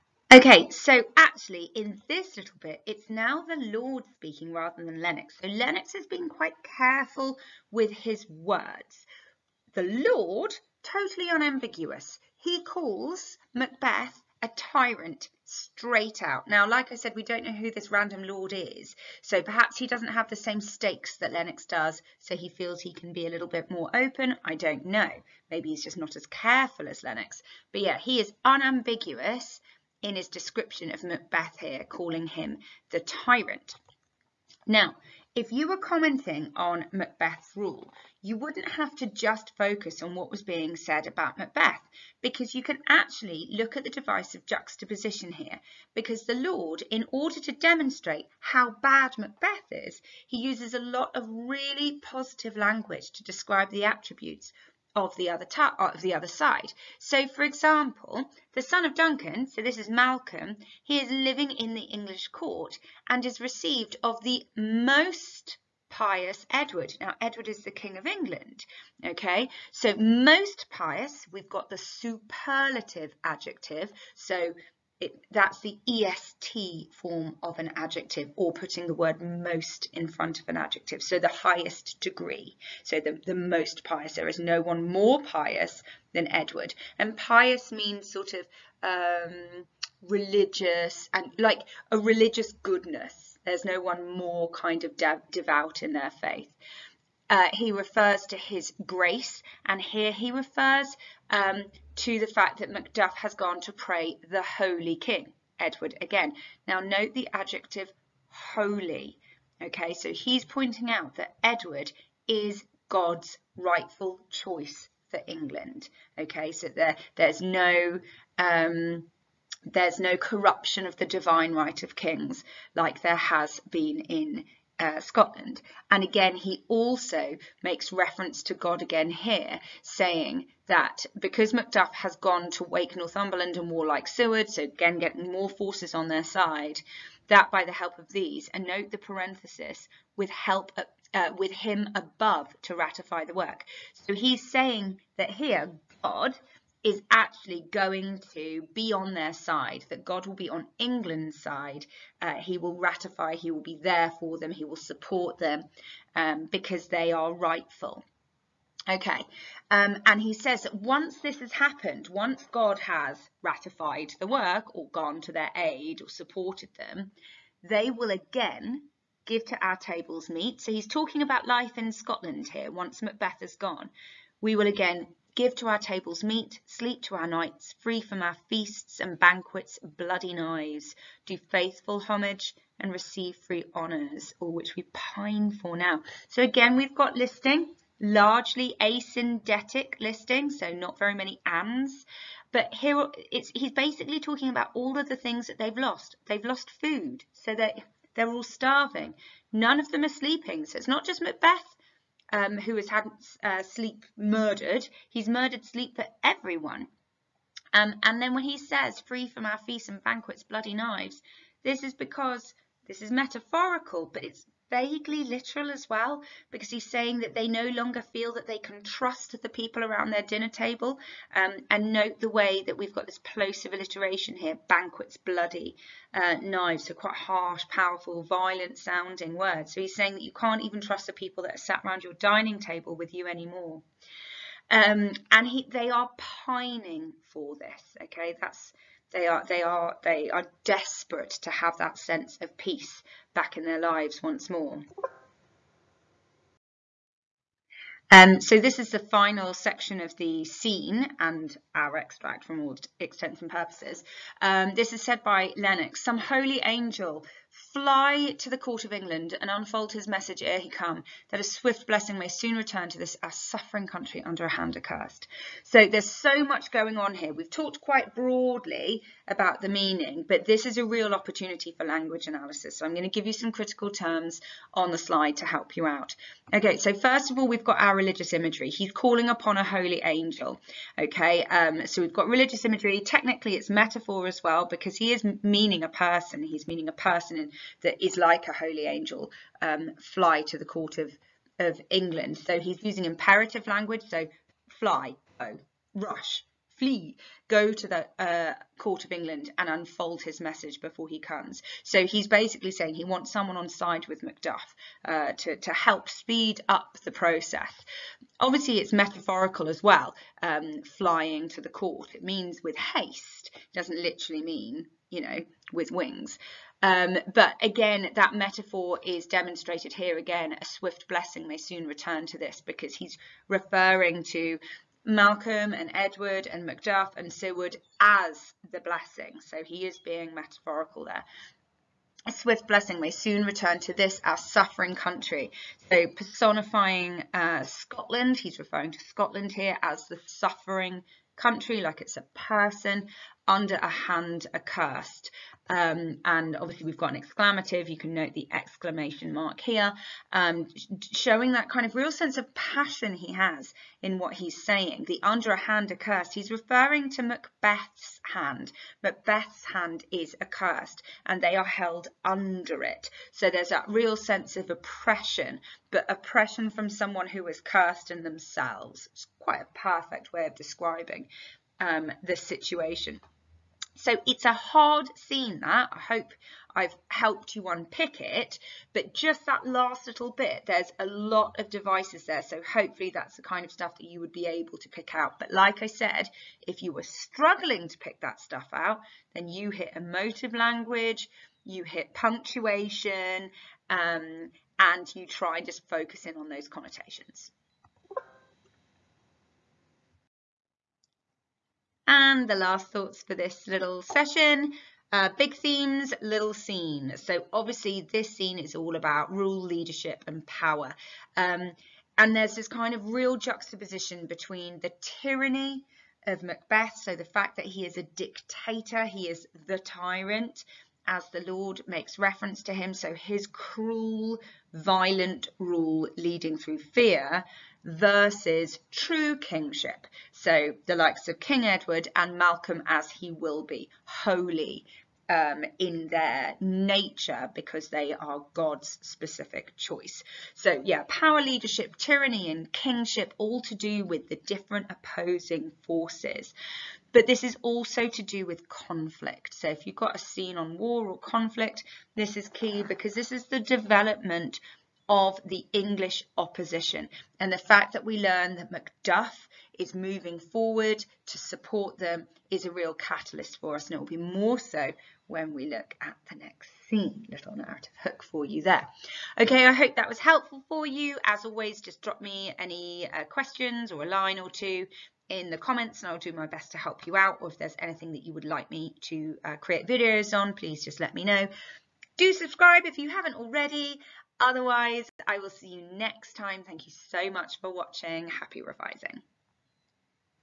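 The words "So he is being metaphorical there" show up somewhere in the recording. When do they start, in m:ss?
5:29.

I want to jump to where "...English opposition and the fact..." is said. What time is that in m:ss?
7:35.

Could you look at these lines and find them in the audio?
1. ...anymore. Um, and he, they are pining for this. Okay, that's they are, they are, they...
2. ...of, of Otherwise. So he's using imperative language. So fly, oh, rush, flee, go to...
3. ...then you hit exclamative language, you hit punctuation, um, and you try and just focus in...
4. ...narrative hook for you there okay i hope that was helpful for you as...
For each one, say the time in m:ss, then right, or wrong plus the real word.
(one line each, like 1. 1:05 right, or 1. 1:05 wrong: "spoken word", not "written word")
1. 3:53 right
2. 4:50 wrong: "England", not "Otherwise"
3. 6:29 wrong: "emotive", not "exclamative"
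4. 7:47 right.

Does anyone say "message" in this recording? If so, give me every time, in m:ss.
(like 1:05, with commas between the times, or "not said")
4:20, 5:00.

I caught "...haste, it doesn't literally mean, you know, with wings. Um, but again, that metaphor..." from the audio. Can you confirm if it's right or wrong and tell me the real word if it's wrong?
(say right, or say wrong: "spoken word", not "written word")
right.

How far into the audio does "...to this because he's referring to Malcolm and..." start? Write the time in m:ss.
5:22.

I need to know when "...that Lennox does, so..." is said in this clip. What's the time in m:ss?
0:21.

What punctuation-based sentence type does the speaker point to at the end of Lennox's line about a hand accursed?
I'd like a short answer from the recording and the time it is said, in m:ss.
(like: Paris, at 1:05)
exclamative, at 5:47.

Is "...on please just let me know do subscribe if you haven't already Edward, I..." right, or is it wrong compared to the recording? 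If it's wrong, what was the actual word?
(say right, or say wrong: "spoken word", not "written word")
wrong: "Otherwise", not "Edward".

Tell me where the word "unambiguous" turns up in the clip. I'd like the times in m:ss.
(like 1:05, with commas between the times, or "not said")
0:11, 0:28.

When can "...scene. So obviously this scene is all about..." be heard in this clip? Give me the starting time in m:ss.
6:46.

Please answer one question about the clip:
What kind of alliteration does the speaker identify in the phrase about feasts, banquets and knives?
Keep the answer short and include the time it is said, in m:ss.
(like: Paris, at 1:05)
plosive alliteration, at 3:43.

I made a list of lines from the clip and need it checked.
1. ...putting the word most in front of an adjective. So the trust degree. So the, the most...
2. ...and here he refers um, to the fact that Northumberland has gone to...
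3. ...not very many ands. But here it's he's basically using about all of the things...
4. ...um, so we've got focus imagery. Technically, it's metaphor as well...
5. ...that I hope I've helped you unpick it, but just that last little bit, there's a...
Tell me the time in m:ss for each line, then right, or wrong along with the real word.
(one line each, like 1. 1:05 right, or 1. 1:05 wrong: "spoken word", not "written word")
1. 1:18 wrong: "highest", not "trust"
2. 1:39 wrong: "Macduff", not "Northumberland"
3. 3:10 wrong: "talking", not "using"
4. 4:41 wrong: "religious", not "focus"
5. 6:15 right.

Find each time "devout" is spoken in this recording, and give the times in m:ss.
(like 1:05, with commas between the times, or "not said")
1:34.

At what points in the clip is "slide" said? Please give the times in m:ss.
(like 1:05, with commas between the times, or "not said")
4:34.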